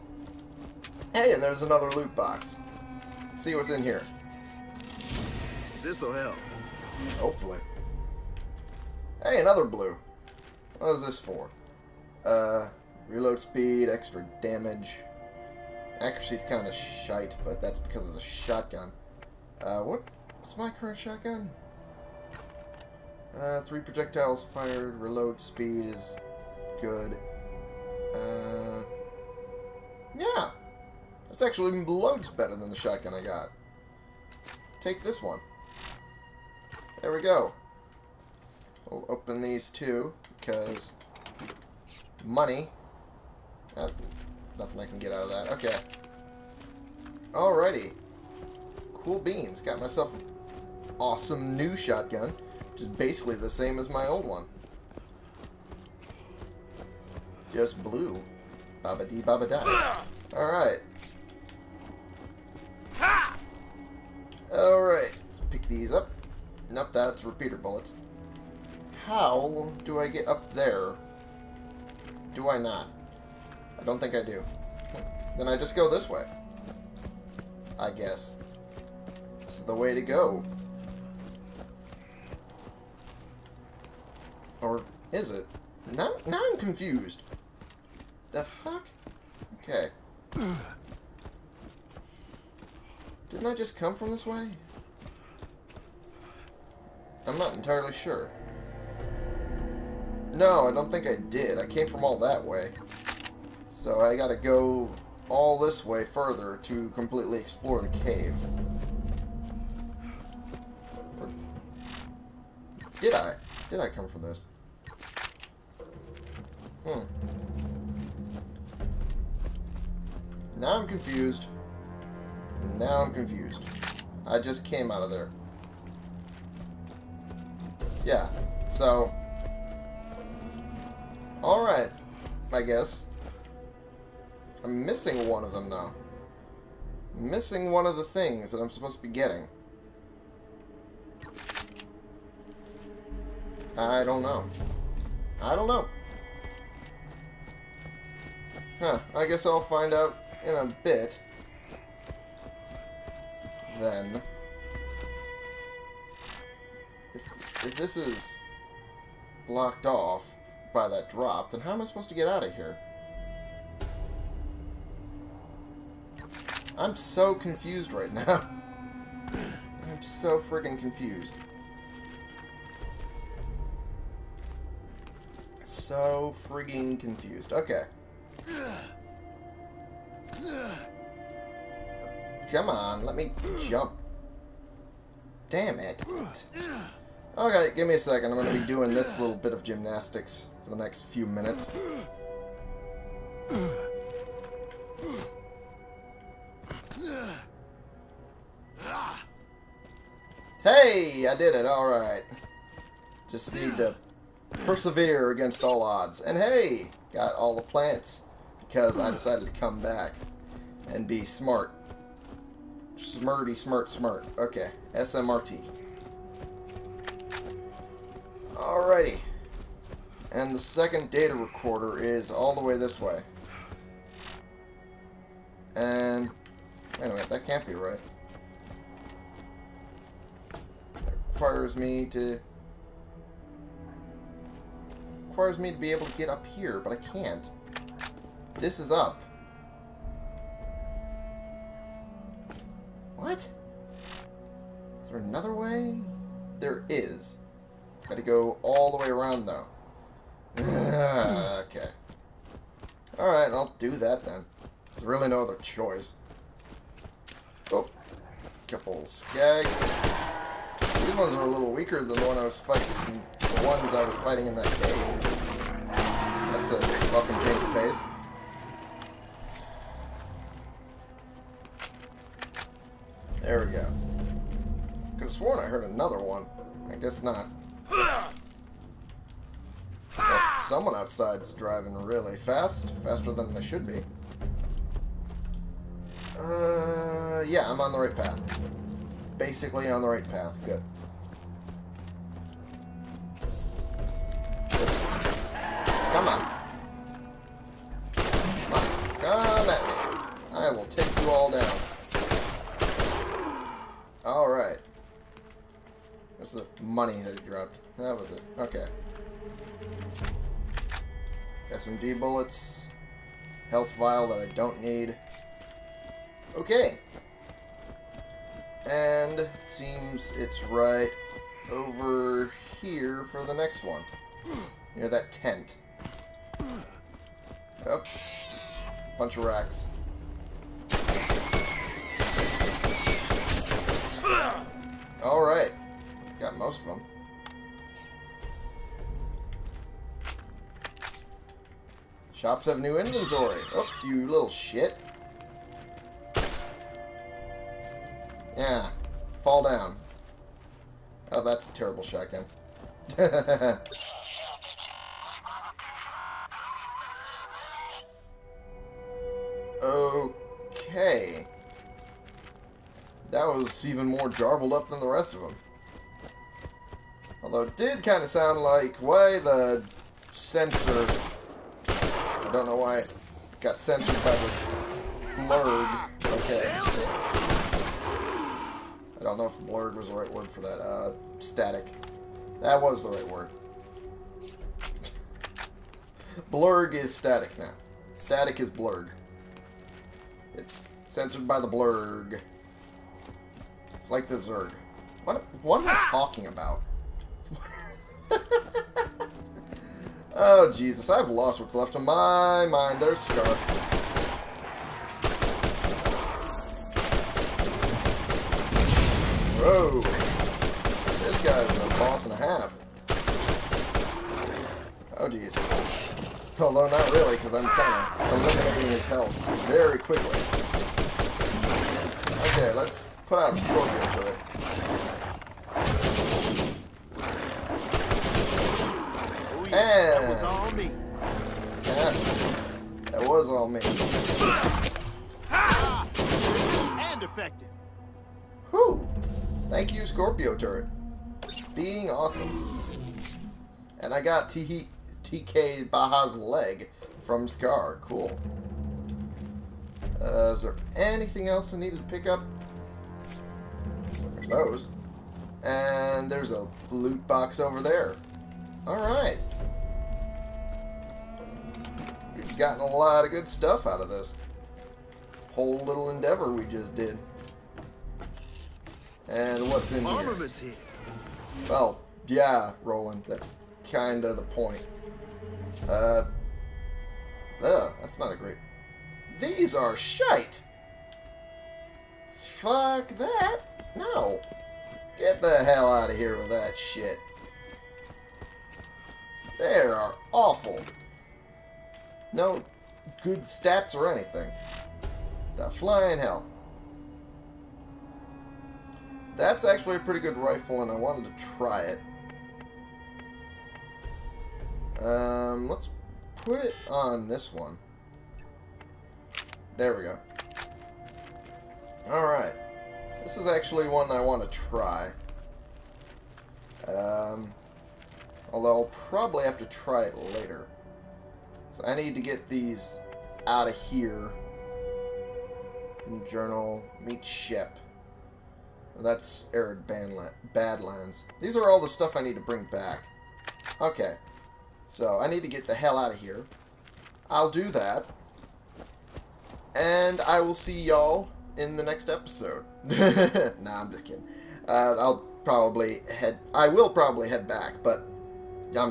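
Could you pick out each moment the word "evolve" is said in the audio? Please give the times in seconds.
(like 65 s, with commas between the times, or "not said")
not said.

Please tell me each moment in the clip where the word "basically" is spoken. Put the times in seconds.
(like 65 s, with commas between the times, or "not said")
52 s, 289 s.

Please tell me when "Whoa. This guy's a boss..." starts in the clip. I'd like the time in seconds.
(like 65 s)
409 s.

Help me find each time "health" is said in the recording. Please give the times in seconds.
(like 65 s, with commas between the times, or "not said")
313 s, 419 s.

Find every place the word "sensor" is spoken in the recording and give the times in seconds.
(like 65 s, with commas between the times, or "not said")
370 s.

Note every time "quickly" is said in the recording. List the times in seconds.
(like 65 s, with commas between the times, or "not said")
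419 s.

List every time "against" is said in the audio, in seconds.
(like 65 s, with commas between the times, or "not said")
205 s.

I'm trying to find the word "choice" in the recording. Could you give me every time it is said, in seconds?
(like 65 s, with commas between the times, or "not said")
255 s.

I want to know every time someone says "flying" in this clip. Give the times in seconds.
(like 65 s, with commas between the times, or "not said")
495 s.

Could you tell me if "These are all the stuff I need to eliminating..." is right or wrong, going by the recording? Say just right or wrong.
wrong.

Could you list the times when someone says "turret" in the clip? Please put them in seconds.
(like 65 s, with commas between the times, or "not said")
440 s.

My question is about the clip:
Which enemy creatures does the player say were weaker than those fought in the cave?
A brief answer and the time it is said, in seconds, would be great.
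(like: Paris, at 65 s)
Skags, at 259 s.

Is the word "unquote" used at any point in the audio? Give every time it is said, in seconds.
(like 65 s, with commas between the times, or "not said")
not said.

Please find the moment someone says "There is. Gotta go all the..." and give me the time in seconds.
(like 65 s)
246 s.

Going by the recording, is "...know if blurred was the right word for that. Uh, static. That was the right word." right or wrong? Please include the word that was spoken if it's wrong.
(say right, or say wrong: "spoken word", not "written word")
right.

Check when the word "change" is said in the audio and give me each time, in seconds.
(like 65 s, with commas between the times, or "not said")
267 s.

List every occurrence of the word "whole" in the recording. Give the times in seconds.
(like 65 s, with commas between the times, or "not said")
465 s.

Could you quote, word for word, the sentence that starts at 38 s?
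We'll open these two, because money.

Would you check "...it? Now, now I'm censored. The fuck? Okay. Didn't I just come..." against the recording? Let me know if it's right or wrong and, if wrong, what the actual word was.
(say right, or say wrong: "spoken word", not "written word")
wrong: "confused", not "censored".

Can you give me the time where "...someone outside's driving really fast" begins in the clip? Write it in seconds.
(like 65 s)
280 s.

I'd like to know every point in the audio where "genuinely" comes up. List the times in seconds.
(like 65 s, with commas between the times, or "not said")
not said.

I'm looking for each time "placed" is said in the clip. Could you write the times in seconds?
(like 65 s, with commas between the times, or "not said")
not said.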